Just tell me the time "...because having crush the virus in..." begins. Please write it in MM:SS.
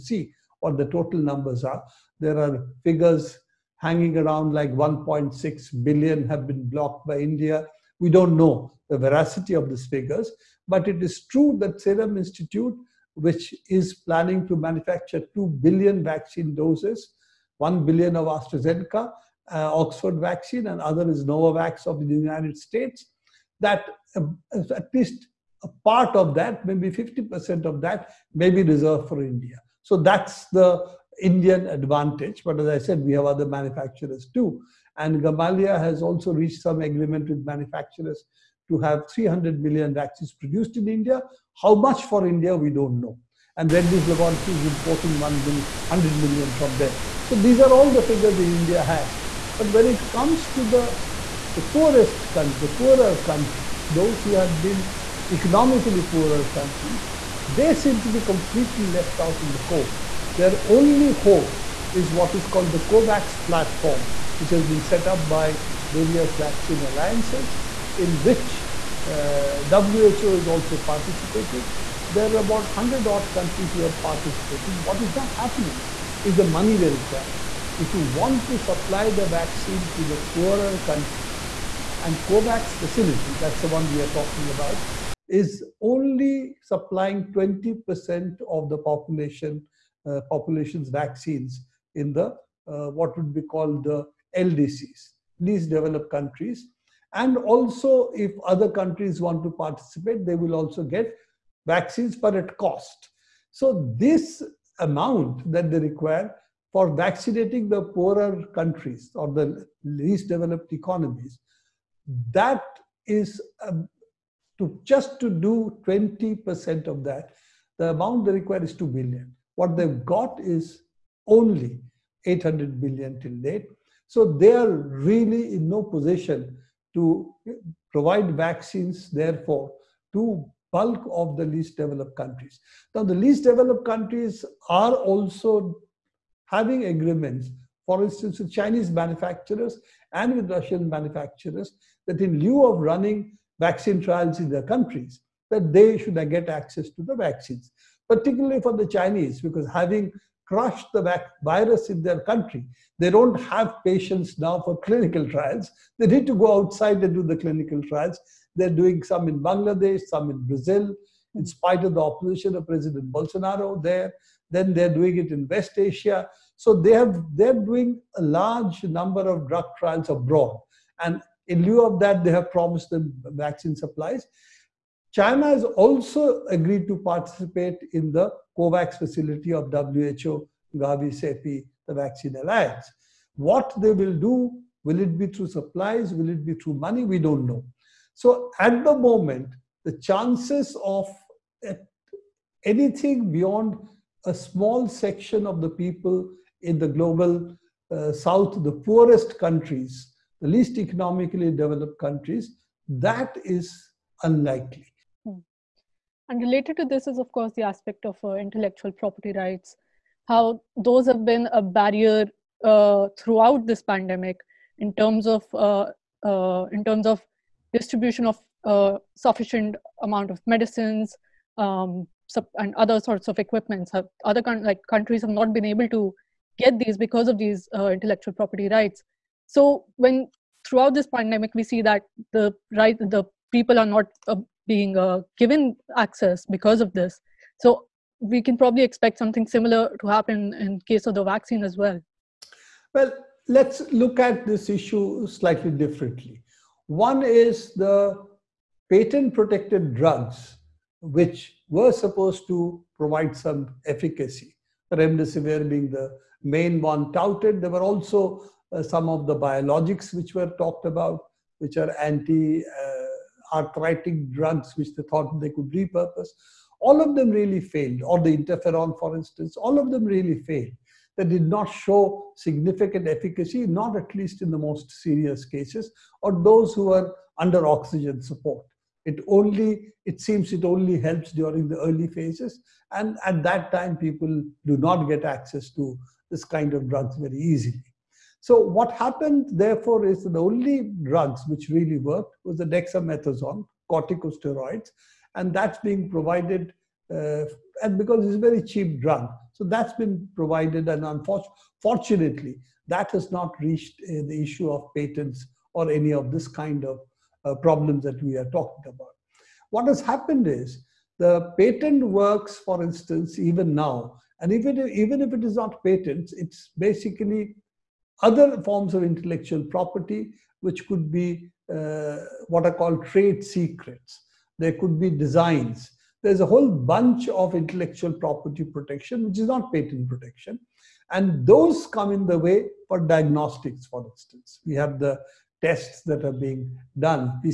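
02:29.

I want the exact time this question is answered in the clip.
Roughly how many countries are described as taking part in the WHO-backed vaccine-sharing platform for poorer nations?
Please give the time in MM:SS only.
01:12.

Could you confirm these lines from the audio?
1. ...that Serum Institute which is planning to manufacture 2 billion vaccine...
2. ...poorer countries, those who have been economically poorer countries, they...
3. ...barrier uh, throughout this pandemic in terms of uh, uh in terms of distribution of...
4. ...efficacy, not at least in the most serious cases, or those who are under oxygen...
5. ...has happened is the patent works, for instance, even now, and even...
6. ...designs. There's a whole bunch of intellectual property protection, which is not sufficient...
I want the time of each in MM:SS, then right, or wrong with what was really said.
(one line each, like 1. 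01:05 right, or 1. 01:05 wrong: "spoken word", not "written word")
1. 00:11 right
2. 00:52 right
3. 03:31 right
4. 04:33 right
5. 05:09 right
6. 05:25 wrong: "patent", not "sufficient".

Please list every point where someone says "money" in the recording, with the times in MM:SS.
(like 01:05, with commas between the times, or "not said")
01:16, 03:06.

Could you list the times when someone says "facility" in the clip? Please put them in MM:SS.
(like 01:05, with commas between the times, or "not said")
01:22, 02:58.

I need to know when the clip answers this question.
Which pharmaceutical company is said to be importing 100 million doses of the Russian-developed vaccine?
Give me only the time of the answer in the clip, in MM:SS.
00:43.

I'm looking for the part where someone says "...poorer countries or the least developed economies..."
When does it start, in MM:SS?
01:47.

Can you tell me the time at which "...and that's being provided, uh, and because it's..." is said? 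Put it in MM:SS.
04:55.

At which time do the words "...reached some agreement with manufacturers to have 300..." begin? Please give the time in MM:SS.
00:36.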